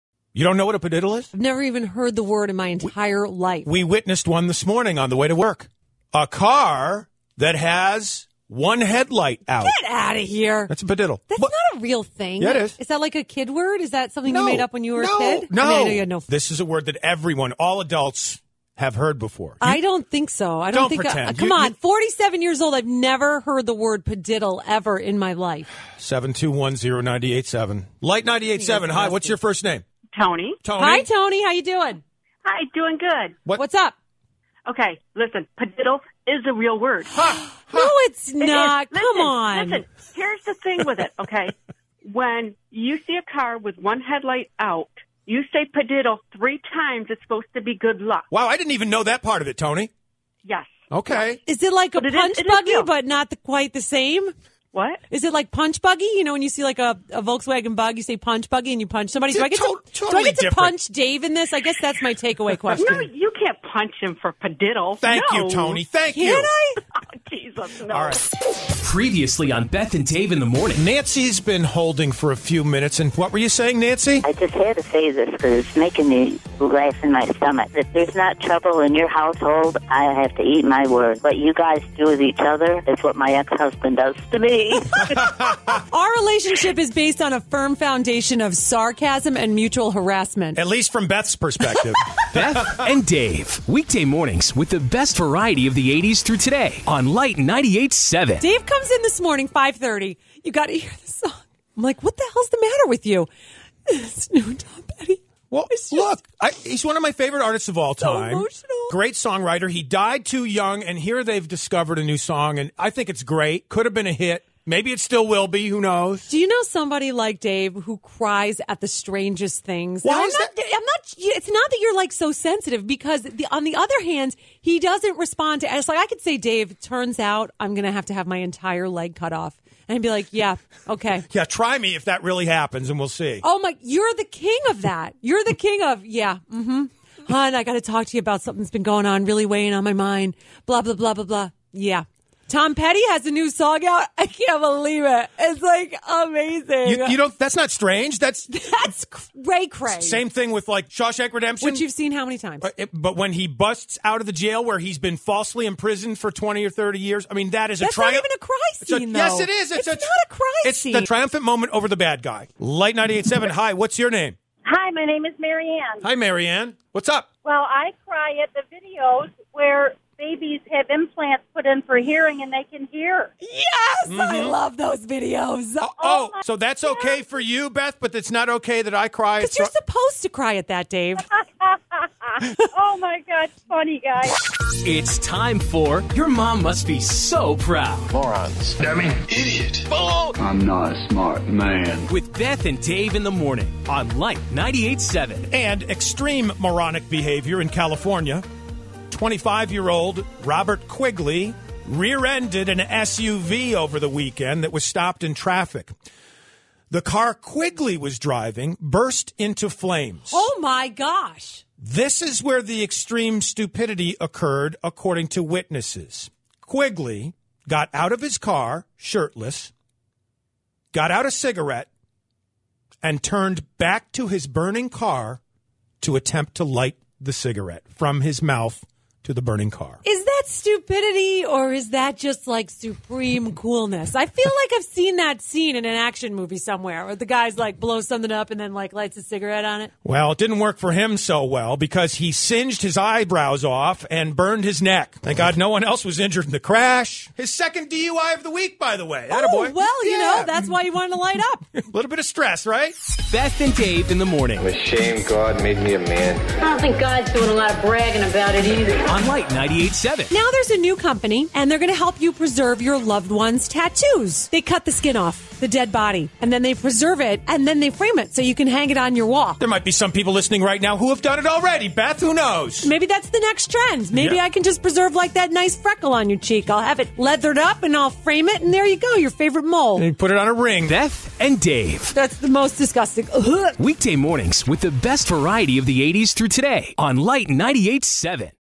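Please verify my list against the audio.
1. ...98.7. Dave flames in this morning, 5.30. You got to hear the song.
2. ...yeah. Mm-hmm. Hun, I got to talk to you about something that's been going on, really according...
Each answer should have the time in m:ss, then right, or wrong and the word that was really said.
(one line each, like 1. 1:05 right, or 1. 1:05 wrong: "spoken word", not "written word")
1. 1:37 wrong: "comes", not "flames"
2. 2:16 wrong: "weighing", not "according".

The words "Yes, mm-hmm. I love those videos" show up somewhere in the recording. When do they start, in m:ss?
2:53.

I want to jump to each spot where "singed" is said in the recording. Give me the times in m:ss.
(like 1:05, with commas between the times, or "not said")
4:02.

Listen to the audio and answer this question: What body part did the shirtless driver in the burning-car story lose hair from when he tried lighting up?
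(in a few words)
eyebrows.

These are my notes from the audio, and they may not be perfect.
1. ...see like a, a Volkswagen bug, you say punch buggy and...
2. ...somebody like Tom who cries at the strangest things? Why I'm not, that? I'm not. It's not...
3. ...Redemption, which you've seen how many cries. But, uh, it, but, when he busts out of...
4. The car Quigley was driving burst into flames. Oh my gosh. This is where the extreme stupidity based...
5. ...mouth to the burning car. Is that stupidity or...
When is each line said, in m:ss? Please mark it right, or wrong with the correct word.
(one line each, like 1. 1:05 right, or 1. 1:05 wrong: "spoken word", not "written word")
1. 0:56 right
2. 1:56 wrong: "Dave", not "Tom"
3. 2:31 wrong: "times", not "cries"
4. 3:26 wrong: "occurred", not "based"
5. 3:48 right.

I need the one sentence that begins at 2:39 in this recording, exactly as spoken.
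It's, it's a, not a cry it's scene.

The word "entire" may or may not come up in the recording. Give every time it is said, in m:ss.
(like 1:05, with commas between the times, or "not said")
0:02, 2:08.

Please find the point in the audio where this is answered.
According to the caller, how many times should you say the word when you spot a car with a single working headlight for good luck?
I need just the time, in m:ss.
0:46.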